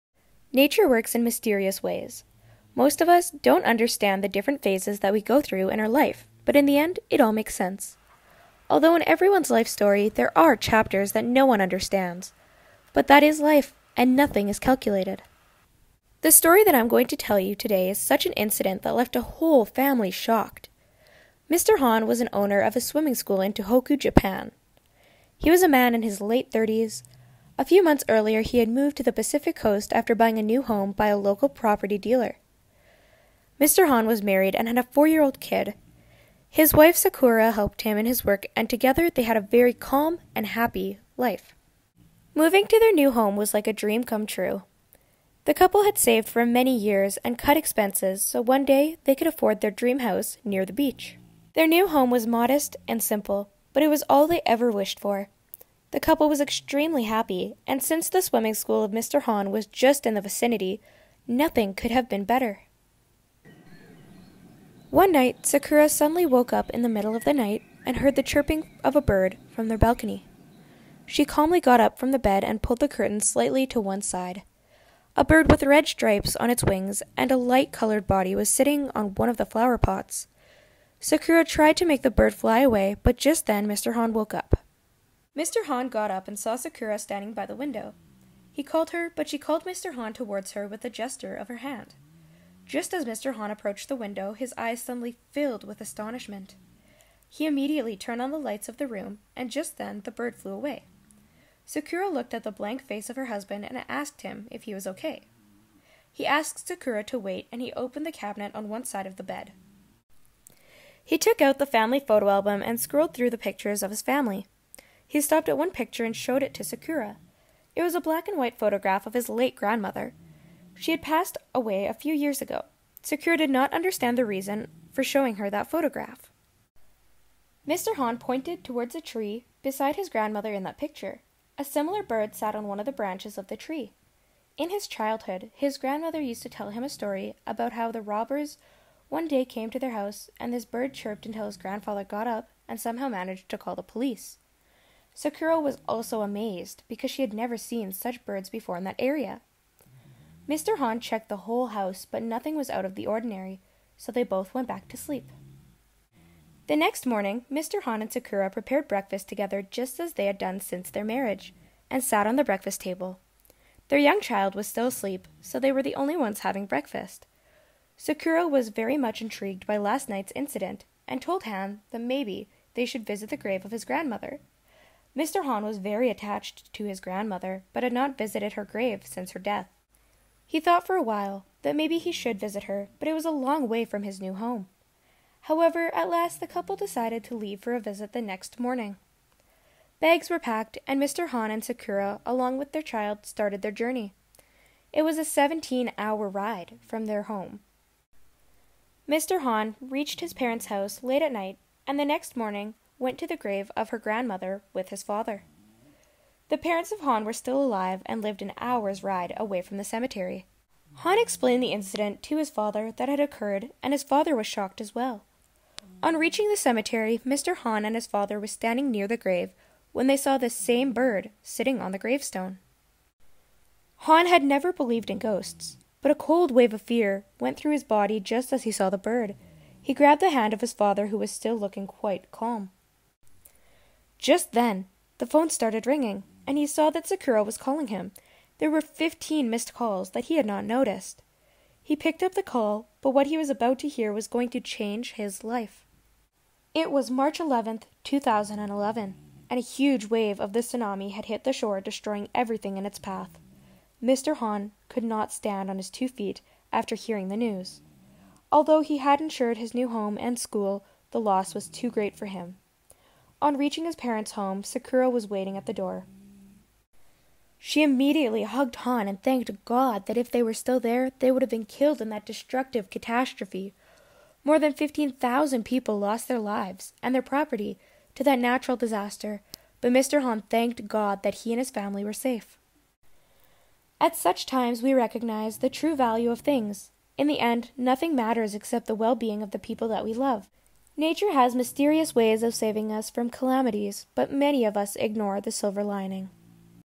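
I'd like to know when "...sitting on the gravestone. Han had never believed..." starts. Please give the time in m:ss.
3:41.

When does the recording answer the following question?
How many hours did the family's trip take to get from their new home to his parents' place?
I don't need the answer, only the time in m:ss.
3:15.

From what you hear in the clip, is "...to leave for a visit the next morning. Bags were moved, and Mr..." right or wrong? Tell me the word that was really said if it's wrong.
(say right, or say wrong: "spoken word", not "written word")
wrong: "packed", not "moved".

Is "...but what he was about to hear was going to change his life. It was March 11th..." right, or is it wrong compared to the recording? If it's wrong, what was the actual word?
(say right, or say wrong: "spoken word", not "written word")
right.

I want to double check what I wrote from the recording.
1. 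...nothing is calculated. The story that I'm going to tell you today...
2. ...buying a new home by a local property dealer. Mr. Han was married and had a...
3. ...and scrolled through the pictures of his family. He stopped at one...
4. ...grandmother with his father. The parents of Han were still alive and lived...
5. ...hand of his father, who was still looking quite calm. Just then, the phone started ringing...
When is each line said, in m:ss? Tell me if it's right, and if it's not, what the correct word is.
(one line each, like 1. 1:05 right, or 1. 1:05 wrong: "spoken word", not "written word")
1. 0:14 right
2. 0:30 right
3. 1:52 right
4. 3:23 right
5. 3:50 right.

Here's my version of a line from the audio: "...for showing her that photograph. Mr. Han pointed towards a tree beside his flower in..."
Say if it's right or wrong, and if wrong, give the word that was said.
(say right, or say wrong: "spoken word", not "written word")
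wrong: "grandmother", not "flower".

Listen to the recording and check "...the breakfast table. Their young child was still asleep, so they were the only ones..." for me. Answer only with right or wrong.
right.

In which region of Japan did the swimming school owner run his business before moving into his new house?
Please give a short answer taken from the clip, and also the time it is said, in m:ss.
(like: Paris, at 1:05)
Tohoku, at 0:23.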